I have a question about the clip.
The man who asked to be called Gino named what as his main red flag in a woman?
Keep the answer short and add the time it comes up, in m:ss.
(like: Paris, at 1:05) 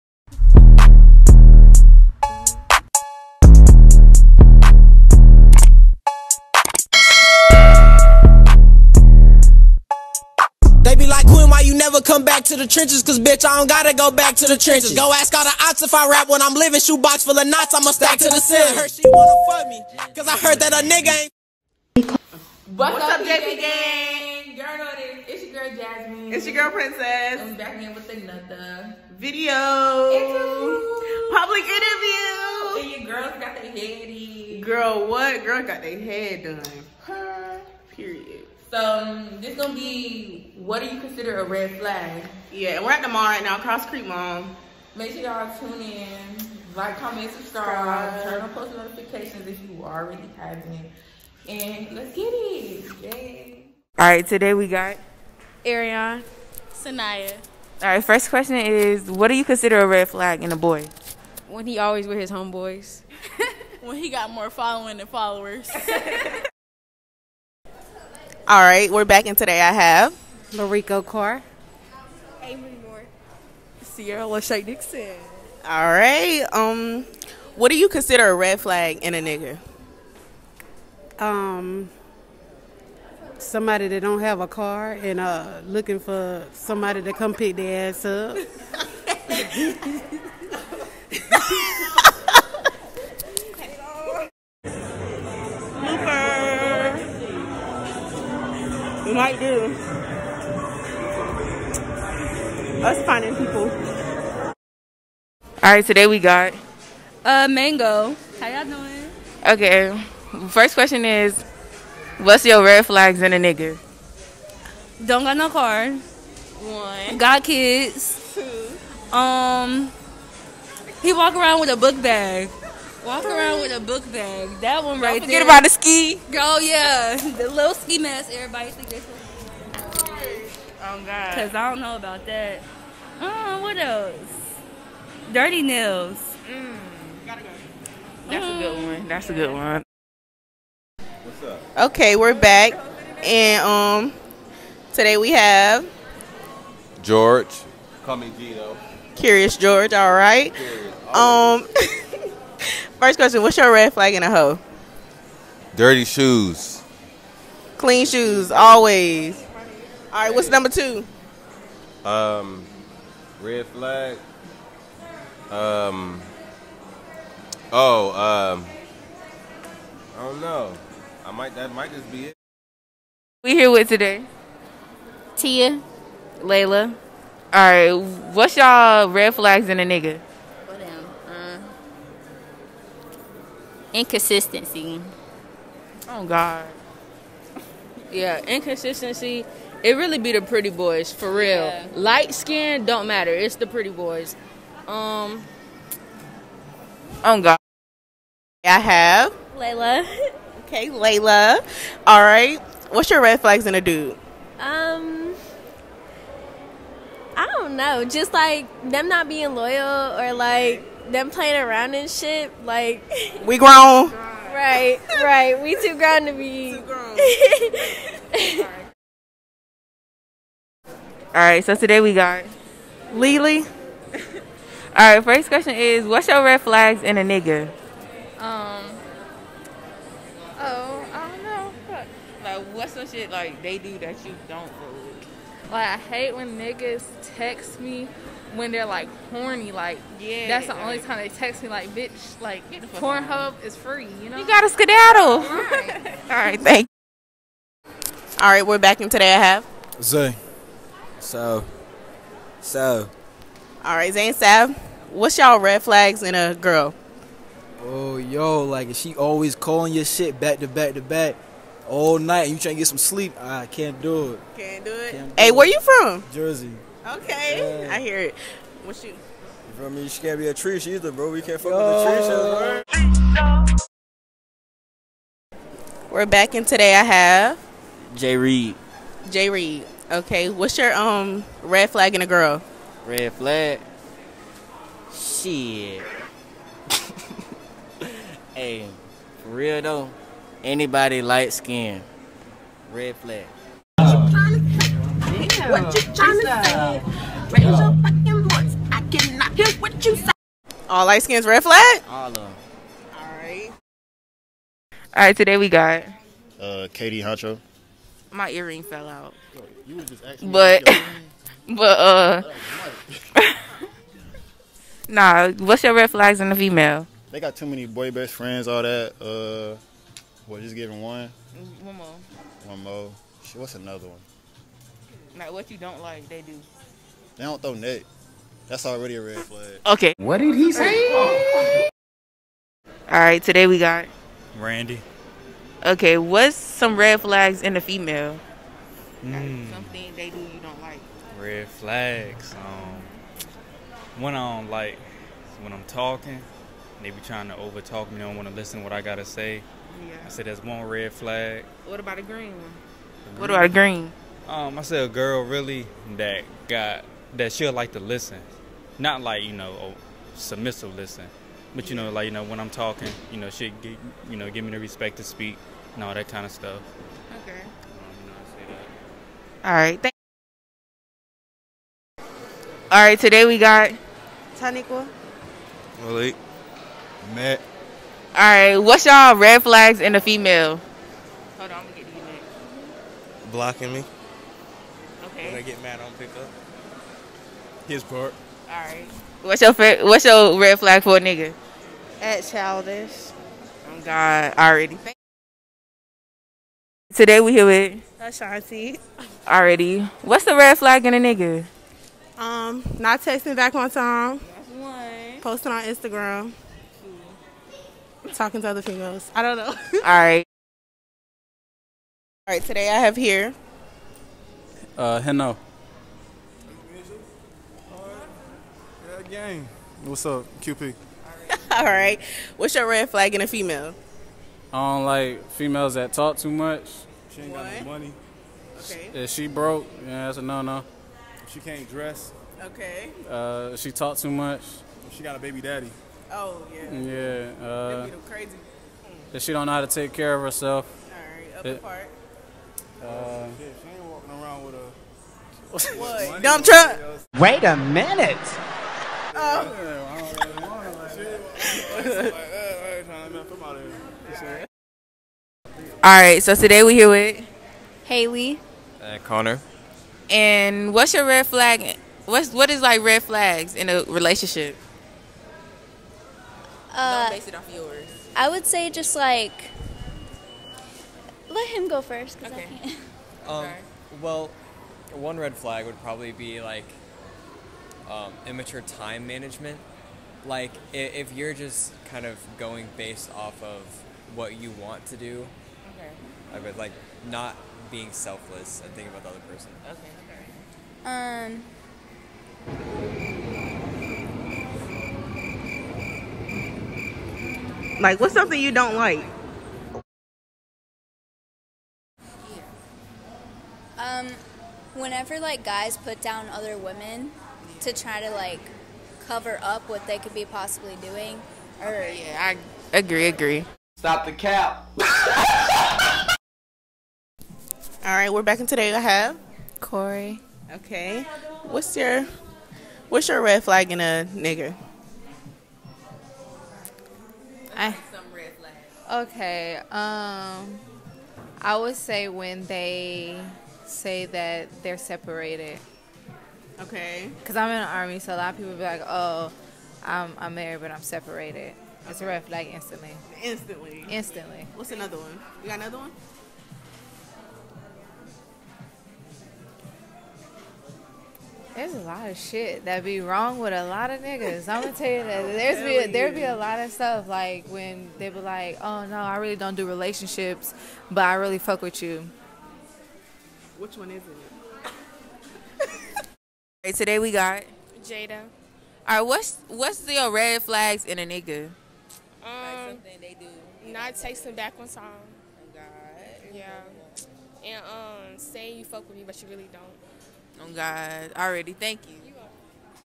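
Dirty shoes, at 2:35.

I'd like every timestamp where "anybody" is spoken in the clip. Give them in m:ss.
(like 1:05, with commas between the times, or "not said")
4:50.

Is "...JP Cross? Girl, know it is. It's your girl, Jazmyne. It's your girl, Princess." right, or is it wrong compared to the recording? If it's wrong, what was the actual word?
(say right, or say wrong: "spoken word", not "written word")
wrong: "Gang", not "Cross".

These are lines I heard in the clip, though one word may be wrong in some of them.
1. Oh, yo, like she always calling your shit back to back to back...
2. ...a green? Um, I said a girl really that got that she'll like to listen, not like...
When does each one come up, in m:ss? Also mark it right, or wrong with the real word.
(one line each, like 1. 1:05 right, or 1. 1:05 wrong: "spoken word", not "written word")
1. 4:17 right
2. 5:53 right.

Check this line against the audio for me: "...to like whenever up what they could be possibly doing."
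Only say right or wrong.
wrong.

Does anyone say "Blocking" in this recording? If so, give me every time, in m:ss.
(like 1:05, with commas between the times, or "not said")
6:23.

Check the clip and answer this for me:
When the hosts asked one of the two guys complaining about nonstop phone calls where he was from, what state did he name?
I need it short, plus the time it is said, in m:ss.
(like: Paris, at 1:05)
Jersey, at 4:26.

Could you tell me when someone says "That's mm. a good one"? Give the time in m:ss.
2:18.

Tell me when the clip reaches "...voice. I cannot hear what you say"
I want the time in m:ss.
4:58.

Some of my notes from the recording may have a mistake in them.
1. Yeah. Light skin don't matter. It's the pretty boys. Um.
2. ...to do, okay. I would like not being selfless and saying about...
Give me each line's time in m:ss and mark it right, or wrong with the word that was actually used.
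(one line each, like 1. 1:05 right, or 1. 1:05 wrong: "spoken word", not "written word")
1. 3:11 right
2. 8:05 wrong: "thinking", not "saying".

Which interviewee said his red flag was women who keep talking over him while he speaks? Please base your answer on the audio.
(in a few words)
Randy.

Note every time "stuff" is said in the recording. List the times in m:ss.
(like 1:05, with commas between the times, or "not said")
6:06, 9:16.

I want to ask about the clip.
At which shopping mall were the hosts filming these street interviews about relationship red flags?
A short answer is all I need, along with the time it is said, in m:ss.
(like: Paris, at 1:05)
Cross Creek Mall, at 0:43.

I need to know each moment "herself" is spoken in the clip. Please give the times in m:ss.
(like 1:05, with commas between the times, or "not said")
7:20.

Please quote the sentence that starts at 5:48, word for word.
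don't want to listen to what I gotta say.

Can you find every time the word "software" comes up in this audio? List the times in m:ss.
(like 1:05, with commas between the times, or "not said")
not said.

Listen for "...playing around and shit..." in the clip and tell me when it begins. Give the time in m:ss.
3:31.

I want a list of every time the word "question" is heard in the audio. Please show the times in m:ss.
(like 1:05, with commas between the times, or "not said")
0:58, 1:50, 2:33, 3:45.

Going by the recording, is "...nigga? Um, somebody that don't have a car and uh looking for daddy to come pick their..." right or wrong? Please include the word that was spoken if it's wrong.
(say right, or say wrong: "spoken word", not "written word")
wrong: "somebody", not "daddy".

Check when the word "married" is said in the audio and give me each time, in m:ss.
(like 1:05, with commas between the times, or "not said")
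9:00.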